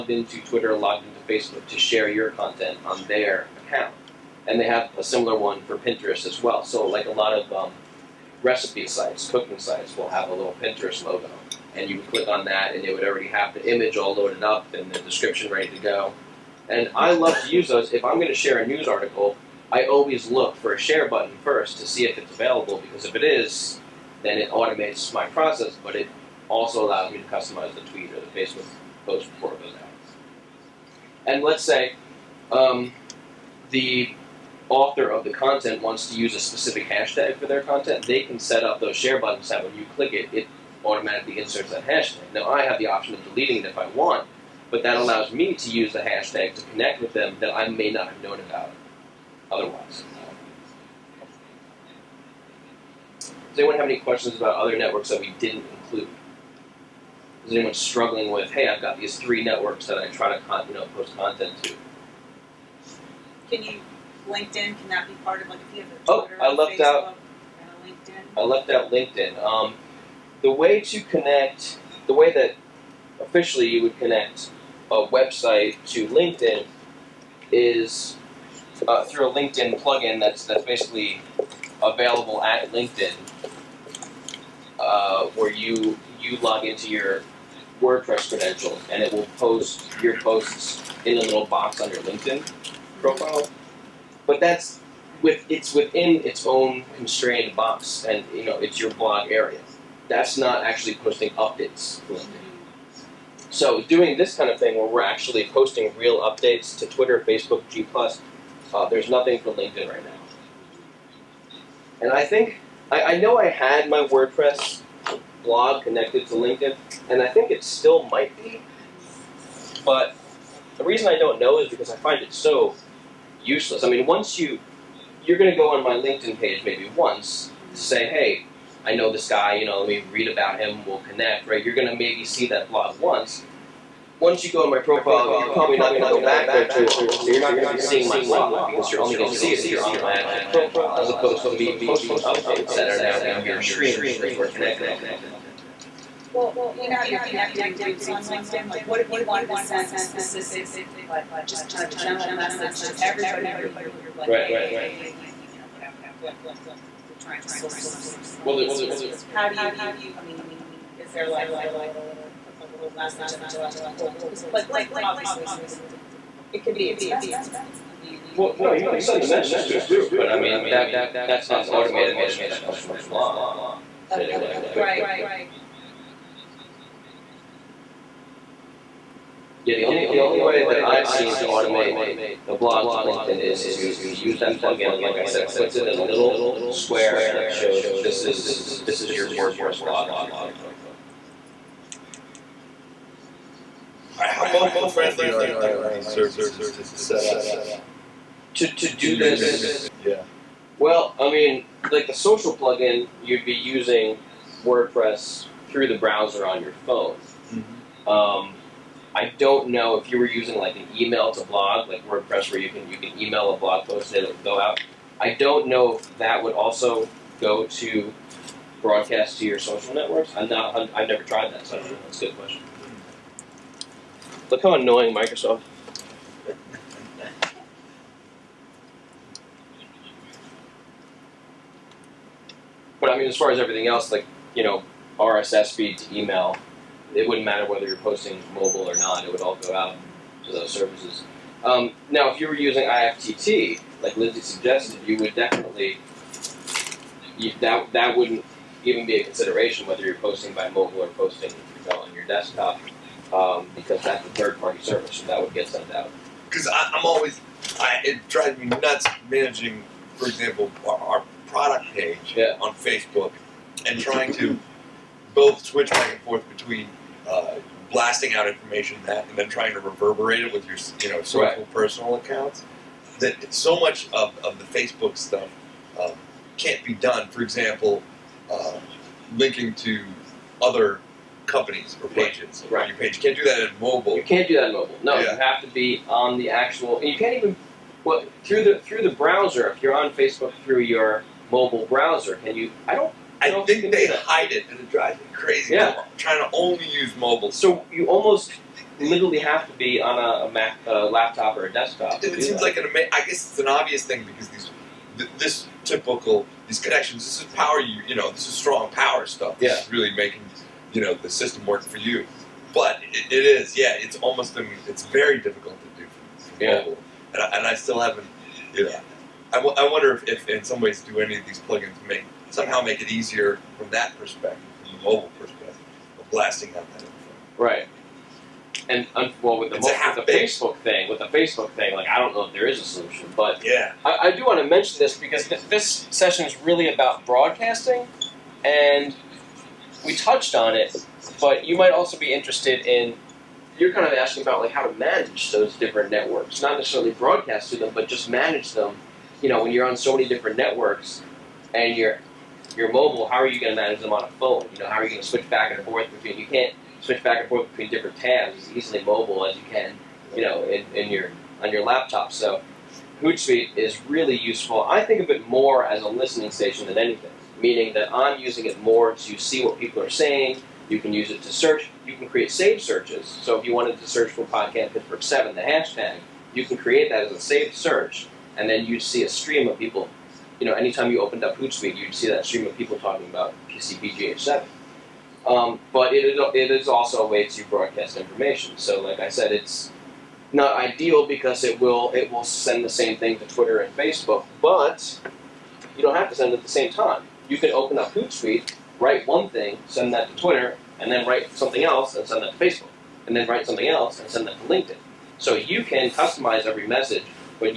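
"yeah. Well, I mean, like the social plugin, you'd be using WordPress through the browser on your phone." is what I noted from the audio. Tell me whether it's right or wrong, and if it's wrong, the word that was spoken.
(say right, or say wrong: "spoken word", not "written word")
right.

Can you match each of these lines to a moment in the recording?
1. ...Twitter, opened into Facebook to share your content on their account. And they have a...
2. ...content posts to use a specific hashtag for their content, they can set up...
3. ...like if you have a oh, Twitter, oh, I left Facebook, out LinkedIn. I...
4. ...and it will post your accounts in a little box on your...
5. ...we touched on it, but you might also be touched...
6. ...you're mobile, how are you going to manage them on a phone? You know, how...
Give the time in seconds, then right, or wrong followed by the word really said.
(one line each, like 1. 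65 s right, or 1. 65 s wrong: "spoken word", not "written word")
1. 0 s wrong: "logged", not "opened"
2. 35 s wrong: "wants", not "posts"
3. 65 s right
4. 88 s wrong: "posts", not "accounts"
5. 340 s wrong: "interested", not "touched"
6. 352 s right.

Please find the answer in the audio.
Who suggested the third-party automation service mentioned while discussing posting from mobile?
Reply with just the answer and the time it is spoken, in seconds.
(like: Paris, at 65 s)
Lindsay, at 244 s.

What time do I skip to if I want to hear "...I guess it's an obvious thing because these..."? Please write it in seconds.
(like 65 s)
303 s.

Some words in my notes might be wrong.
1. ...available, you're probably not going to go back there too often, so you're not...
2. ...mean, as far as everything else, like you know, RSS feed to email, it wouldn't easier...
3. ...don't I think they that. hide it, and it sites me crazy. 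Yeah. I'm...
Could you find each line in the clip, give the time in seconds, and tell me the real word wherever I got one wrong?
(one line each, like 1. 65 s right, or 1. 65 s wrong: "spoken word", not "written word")
1. 134 s wrong: "profile", not "available"
2. 233 s wrong: "matter", not "easier"
3. 292 s wrong: "drives", not "sites".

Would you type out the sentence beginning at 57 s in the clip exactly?
Is anyone struggling with, hey, I've got these three networks that I try to you know, post content to?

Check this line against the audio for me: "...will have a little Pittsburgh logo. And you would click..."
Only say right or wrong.
wrong.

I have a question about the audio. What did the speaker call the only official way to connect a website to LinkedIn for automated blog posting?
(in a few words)
LinkedIn plugin.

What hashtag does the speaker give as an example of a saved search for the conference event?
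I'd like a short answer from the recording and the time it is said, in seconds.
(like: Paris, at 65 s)
PCPGH7, at 383 s.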